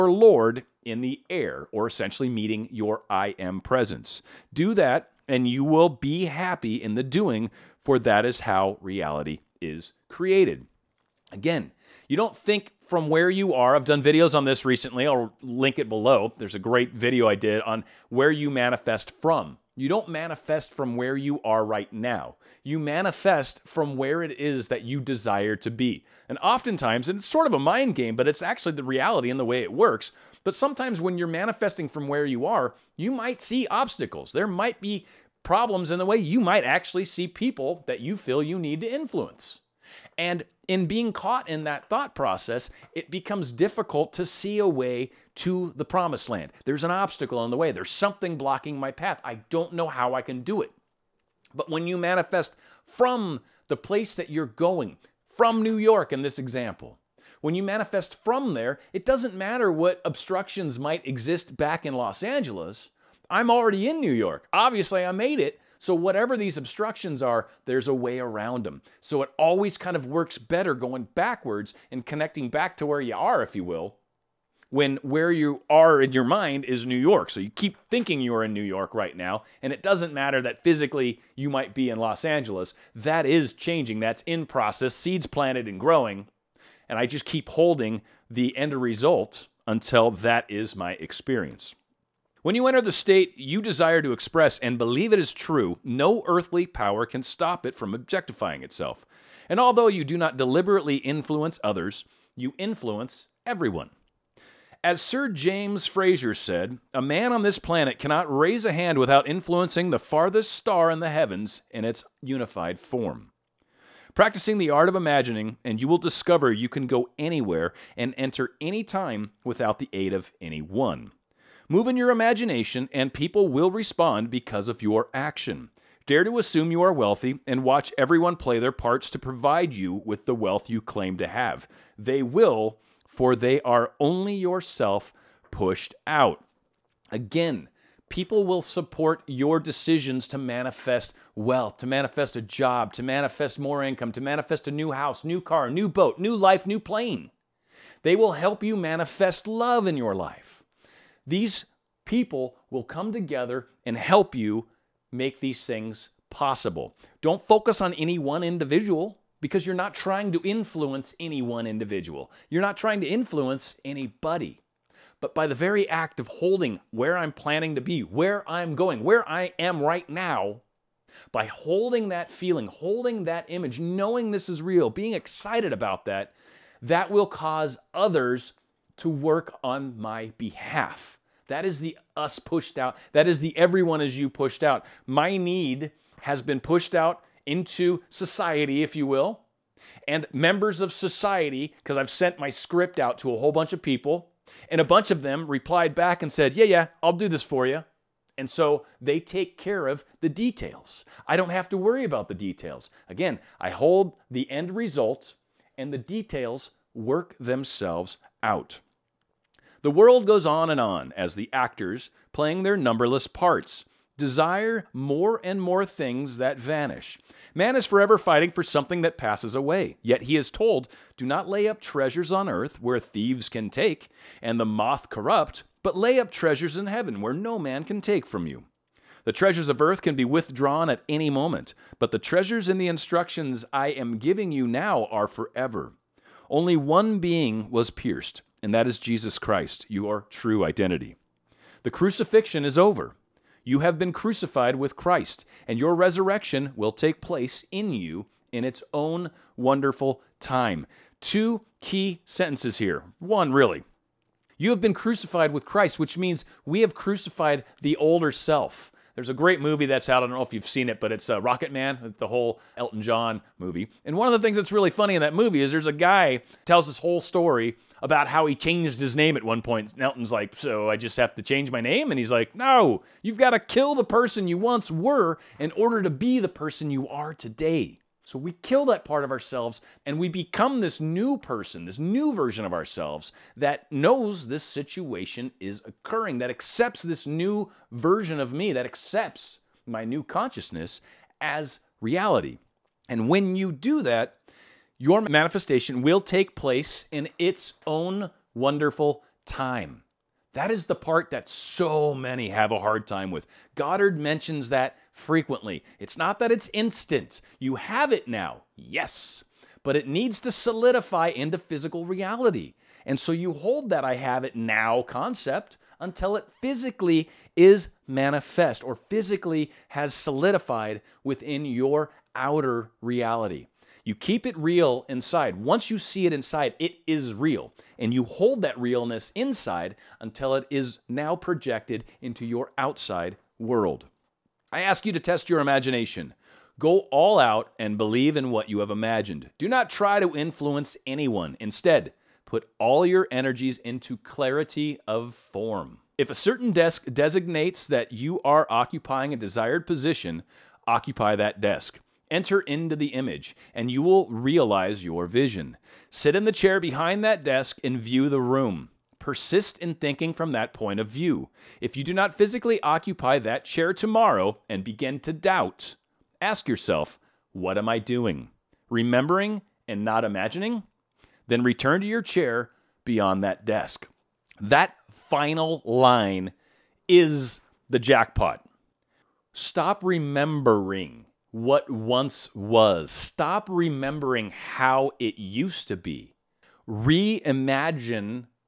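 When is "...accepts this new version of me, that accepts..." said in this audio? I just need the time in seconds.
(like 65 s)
286 s.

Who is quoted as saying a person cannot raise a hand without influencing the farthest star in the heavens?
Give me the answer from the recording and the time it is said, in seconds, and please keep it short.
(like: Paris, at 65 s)
Sir James Fraser, at 105 s.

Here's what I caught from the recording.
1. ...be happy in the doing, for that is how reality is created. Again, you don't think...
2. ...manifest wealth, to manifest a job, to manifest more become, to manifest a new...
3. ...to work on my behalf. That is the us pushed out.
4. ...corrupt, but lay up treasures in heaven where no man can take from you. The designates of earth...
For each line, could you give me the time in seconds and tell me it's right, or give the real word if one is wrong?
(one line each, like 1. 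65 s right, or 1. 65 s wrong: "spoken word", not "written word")
1. 5 s right
2. 140 s wrong: "income", not "become"
3. 178 s right
4. 225 s wrong: "treasures", not "designates".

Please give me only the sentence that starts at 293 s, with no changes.
And when you do that, your manifestation will take place in its own wonderful time.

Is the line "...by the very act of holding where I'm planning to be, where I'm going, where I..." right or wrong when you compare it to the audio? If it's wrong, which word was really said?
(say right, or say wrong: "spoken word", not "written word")
right.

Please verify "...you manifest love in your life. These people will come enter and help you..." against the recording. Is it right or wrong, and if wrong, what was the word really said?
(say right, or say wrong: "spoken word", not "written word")
wrong: "together", not "enter".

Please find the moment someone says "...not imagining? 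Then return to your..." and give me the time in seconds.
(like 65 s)
370 s.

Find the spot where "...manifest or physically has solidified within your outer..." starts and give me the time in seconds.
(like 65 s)
318 s.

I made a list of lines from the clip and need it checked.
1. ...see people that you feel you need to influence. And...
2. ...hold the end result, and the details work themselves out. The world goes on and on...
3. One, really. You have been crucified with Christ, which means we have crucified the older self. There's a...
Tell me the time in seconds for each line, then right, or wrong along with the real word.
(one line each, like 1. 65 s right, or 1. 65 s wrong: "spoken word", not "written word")
1. 37 s right
2. 203 s right
3. 253 s right.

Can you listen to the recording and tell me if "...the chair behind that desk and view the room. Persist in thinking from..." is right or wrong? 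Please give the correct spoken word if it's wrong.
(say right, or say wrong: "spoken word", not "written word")
right.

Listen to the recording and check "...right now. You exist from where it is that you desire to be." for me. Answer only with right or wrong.
wrong.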